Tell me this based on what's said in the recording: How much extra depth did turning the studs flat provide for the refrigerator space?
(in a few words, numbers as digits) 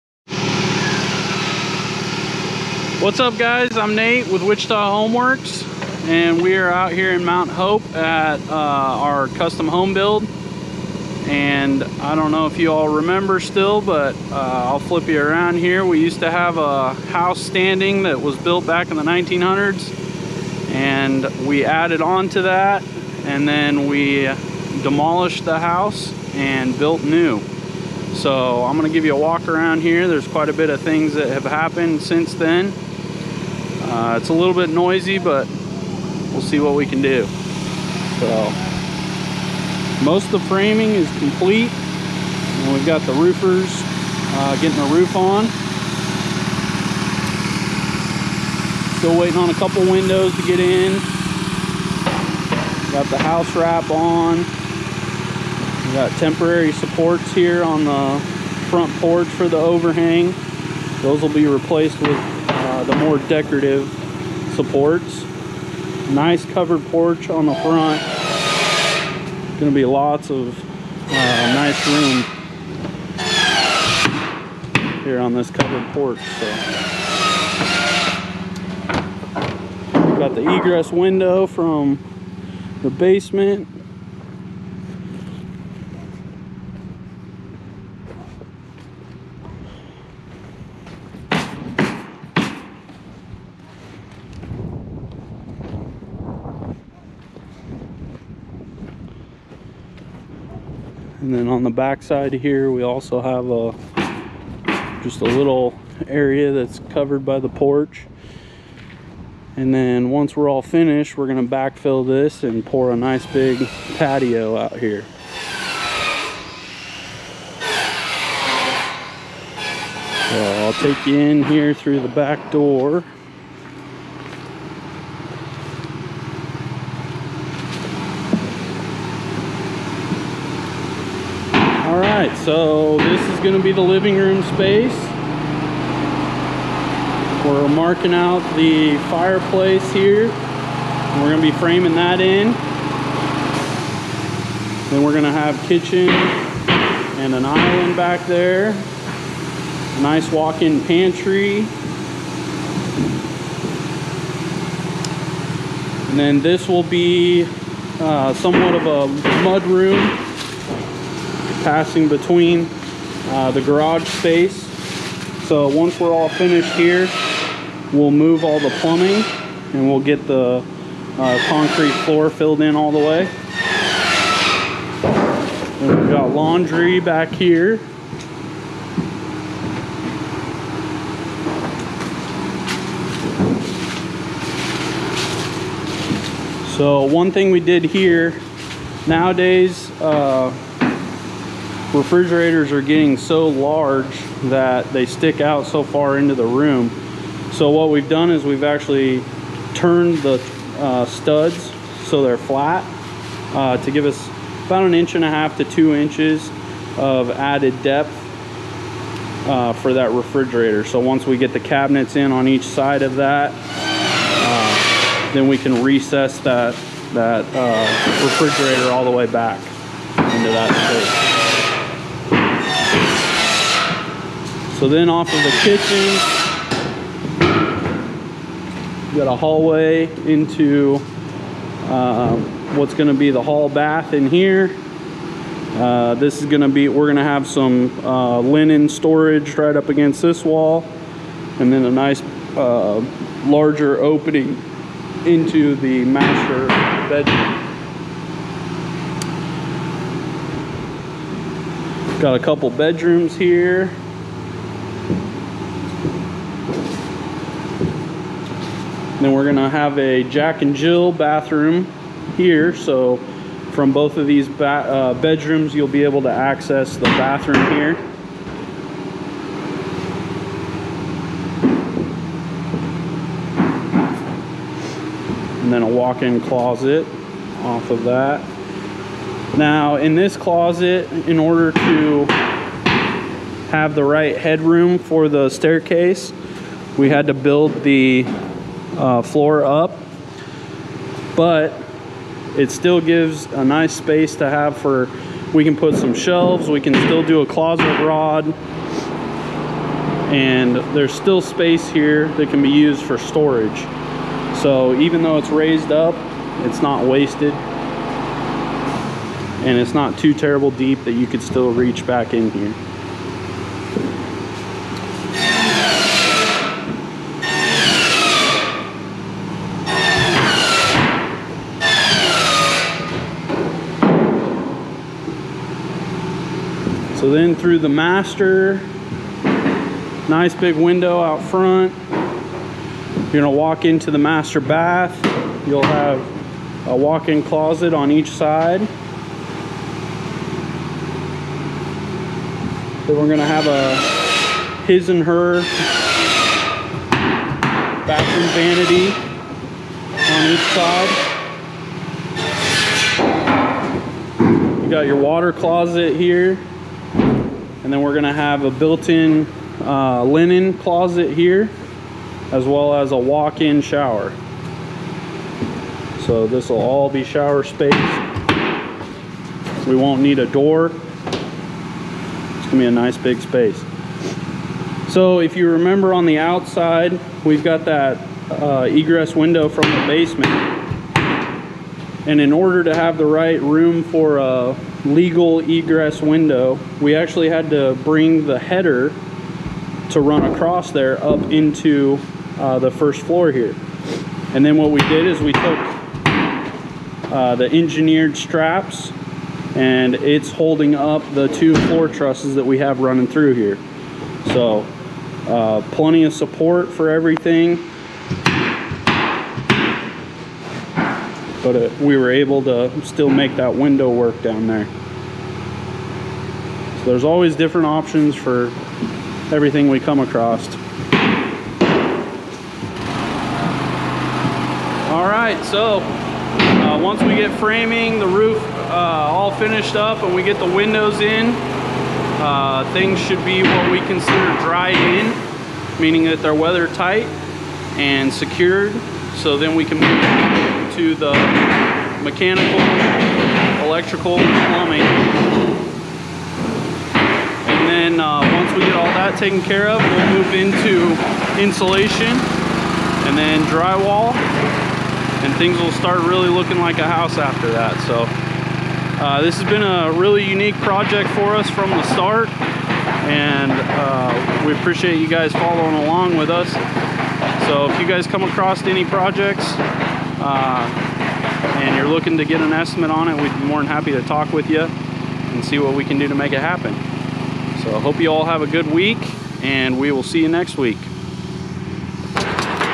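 1.5 to 2 inches.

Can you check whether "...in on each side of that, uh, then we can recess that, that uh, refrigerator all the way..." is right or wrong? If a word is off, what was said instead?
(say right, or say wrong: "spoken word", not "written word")
right.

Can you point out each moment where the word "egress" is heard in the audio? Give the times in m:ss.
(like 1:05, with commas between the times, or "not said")
1:20, 6:18, 6:25.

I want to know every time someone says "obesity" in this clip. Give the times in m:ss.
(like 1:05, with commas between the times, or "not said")
not said.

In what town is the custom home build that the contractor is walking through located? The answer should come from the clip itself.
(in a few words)
Mount Hope.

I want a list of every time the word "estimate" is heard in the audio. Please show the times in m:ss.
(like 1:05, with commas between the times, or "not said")
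7:52.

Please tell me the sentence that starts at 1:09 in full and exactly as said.
Gonna be lots of uh, nice room here on this covered porch.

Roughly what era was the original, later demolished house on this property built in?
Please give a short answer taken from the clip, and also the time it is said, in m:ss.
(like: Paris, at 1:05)
1900s, at 0:19.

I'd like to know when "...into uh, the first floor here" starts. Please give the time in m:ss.
6:31.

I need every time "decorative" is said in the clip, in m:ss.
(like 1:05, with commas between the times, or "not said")
1:03.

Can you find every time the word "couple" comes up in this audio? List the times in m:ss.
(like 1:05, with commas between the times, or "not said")
0:49, 4:12.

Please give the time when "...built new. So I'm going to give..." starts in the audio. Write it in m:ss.
0:26.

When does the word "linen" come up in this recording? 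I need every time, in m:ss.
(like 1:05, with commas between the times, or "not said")
3:58, 6:00.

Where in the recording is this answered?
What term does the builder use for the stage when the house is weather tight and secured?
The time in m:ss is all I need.
7:14.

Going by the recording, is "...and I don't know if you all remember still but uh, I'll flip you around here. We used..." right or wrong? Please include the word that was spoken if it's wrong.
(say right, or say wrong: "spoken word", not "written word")
right.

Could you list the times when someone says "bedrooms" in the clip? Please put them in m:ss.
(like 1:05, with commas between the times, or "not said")
4:07, 4:12, 4:25.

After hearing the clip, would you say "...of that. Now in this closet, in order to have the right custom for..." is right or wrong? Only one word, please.
wrong.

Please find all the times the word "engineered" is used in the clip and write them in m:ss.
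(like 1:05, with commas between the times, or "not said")
6:37.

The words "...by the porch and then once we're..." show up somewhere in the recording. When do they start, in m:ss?
1:47.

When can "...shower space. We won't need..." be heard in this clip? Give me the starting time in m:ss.
6:07.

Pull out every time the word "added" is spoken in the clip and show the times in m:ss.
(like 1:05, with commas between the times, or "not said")
0:21, 3:27.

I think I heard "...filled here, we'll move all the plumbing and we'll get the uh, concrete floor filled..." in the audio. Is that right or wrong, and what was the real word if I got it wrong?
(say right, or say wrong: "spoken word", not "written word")
wrong: "finished", not "filled".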